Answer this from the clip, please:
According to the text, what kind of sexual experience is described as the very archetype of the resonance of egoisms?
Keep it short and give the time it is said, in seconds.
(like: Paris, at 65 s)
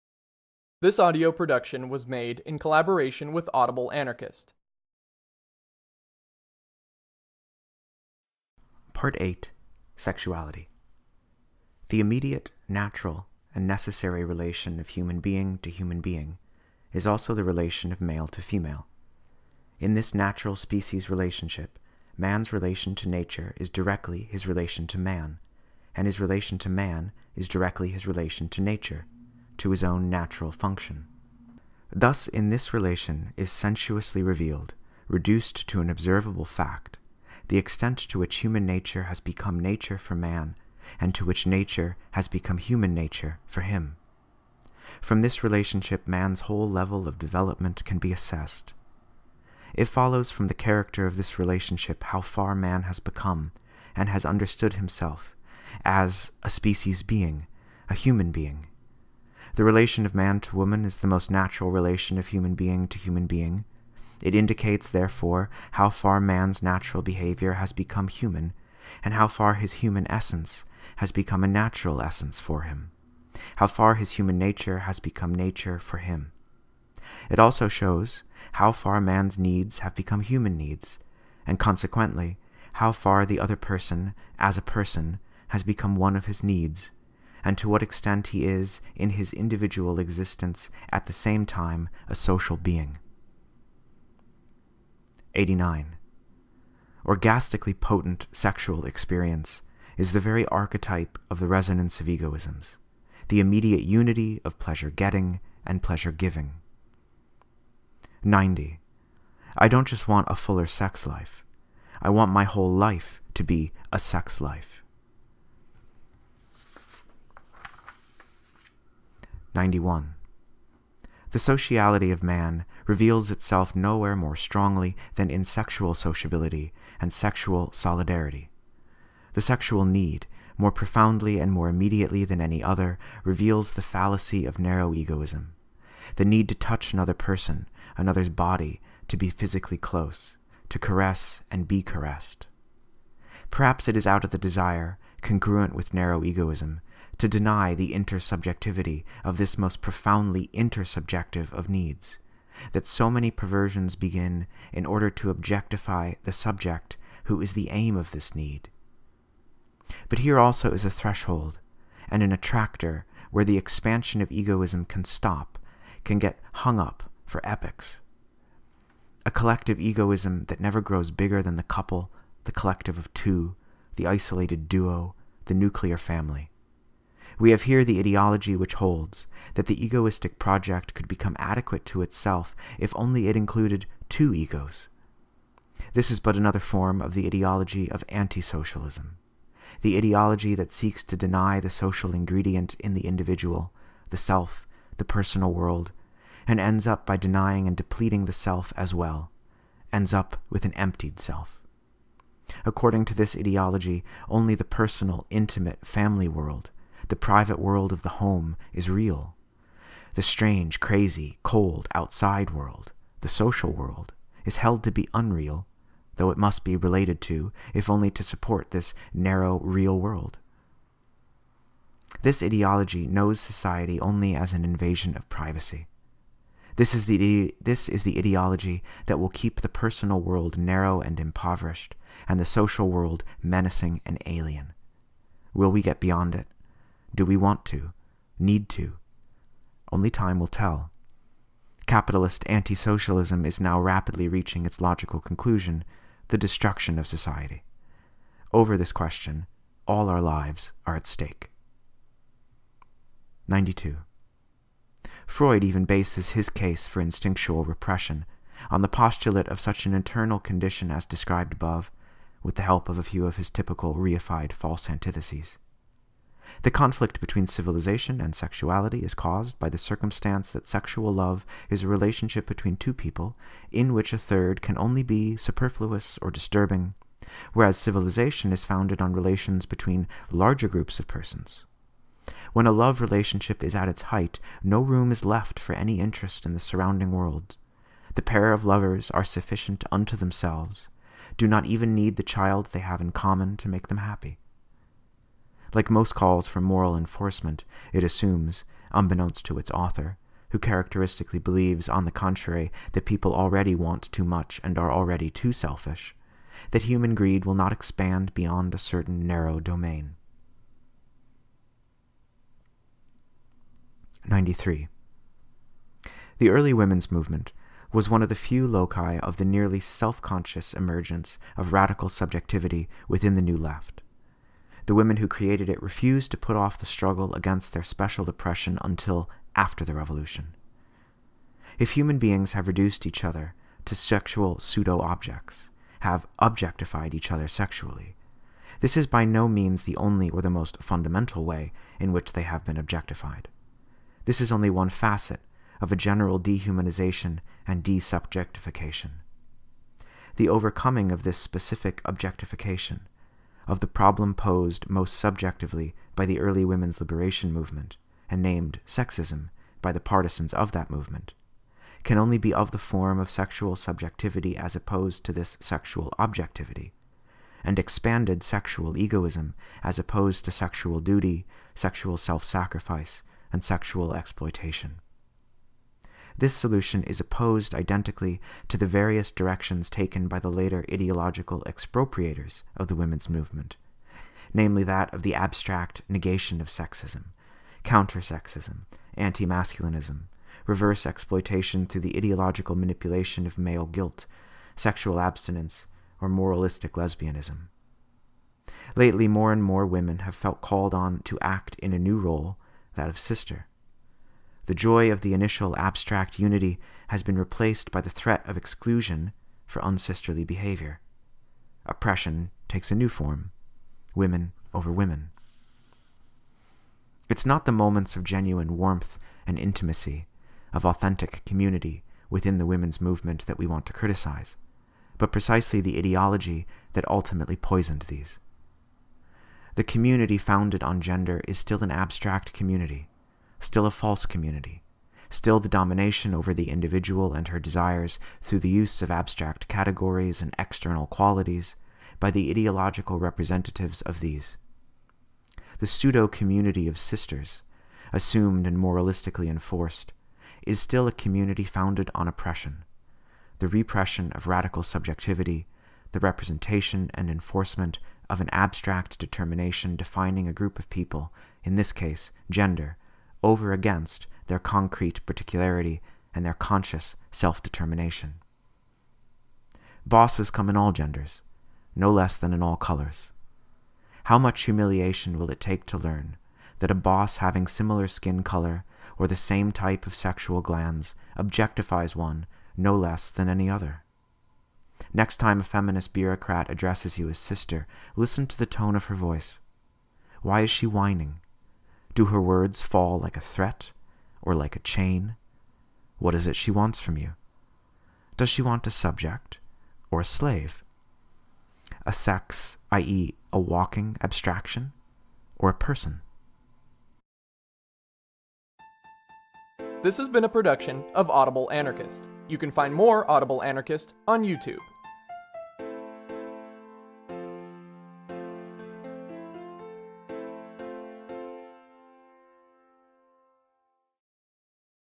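Orgastically potent, at 97 s.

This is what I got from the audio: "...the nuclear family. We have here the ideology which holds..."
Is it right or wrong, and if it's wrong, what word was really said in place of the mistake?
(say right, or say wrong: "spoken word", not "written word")
right.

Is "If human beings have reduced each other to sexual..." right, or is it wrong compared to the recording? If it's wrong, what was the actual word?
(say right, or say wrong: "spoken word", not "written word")
right.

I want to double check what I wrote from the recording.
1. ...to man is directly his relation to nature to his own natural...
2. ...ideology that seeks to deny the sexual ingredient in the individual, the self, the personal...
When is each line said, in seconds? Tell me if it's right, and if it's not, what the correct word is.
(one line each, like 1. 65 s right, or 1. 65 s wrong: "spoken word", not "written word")
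1. 26 s right
2. 189 s wrong: "social", not "sexual".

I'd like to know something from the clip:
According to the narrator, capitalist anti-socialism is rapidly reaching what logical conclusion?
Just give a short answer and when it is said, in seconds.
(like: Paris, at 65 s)
The destruction of society, at 246 s.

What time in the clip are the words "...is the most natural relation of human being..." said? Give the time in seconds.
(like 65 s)
60 s.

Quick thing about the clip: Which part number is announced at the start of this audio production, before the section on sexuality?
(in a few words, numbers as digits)
Part 8.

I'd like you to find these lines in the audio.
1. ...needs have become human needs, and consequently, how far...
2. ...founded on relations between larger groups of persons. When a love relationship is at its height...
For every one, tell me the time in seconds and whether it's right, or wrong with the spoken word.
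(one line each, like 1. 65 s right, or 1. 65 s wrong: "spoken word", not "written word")
1. 79 s right
2. 278 s right.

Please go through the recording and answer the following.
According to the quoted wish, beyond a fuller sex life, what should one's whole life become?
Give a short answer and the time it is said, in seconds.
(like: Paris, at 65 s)
A sex life, at 113 s.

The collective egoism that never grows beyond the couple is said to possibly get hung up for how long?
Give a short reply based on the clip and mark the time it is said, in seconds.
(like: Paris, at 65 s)
Epics, at 167 s.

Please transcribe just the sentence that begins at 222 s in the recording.
This ideology knows society only as an invasion of privacy.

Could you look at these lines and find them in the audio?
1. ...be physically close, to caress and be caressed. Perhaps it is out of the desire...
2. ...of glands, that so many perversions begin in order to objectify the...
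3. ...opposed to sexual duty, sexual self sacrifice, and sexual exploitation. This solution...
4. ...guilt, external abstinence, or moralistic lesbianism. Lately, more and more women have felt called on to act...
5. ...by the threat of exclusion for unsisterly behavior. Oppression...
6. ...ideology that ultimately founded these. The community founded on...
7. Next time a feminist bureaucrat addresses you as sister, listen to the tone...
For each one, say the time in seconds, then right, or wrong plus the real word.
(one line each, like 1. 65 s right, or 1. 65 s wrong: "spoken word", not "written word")
1. 139 s right
2. 151 s wrong: "needs", not "glands"
3. 369 s right
4. 393 s wrong: "sexual", not "external"
5. 407 s right
6. 425 s wrong: "poisoned", not "founded"
7. 485 s right.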